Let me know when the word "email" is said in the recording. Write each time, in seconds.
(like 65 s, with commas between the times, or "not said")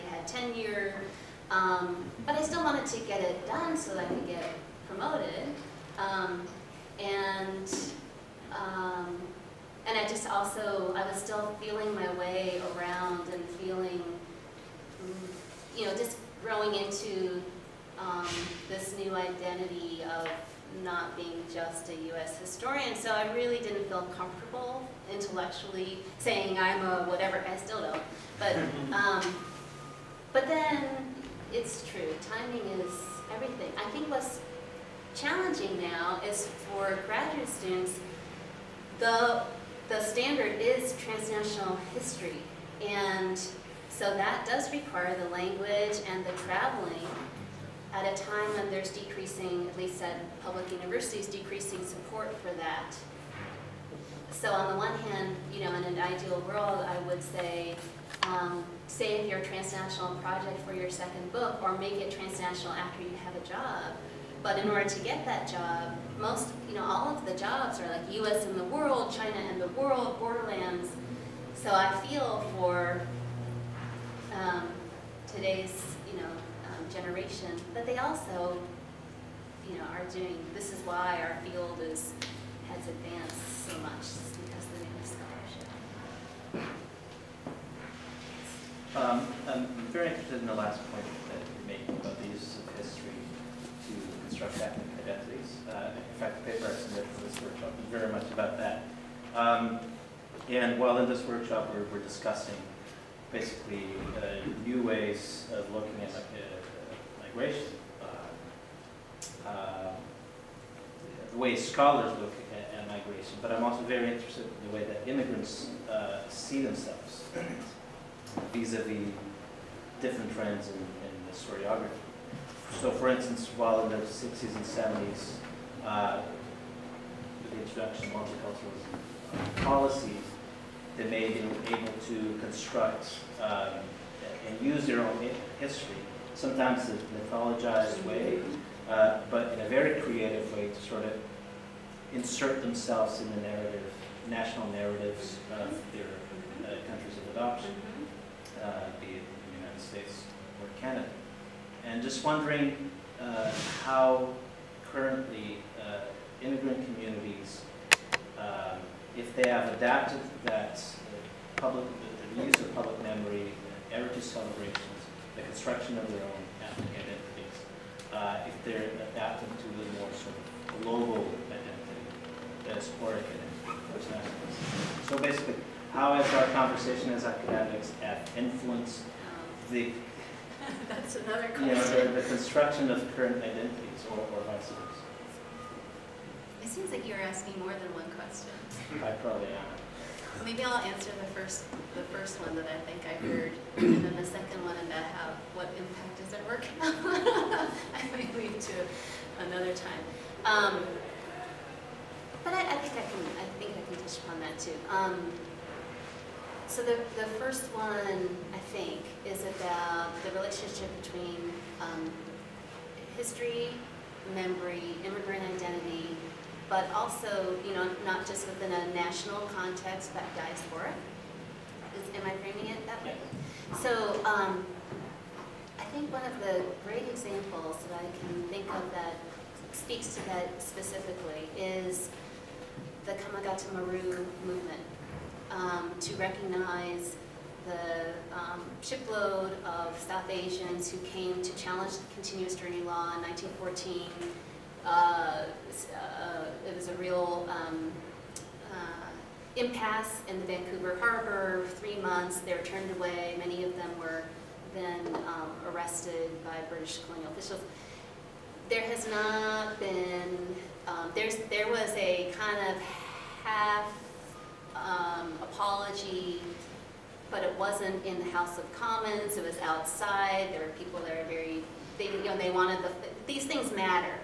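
not said.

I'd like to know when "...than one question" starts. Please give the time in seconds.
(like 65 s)
187 s.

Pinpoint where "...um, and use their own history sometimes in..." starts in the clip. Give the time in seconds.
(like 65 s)
133 s.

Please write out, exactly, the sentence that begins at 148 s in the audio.
uh, be it the United States or Canada.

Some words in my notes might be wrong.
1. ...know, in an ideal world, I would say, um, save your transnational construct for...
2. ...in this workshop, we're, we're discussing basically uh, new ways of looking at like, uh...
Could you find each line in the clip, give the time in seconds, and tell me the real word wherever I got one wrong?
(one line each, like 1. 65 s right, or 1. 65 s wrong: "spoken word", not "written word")
1. 55 s wrong: "project", not "construct"
2. 100 s right.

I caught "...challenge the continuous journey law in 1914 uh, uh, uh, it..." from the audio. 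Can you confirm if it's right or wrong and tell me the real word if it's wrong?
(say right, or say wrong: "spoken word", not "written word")
right.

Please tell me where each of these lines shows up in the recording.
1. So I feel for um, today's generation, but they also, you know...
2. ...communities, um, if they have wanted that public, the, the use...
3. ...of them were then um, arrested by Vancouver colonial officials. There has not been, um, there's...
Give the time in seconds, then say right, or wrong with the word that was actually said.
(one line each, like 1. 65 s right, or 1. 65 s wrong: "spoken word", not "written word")
1. 71 s right
2. 156 s wrong: "adapted", not "wanted"
3. 253 s wrong: "British", not "Vancouver".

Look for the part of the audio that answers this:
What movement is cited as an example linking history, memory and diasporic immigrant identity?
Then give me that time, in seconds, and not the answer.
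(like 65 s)
233 s.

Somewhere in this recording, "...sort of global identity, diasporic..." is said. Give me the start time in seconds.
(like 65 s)
170 s.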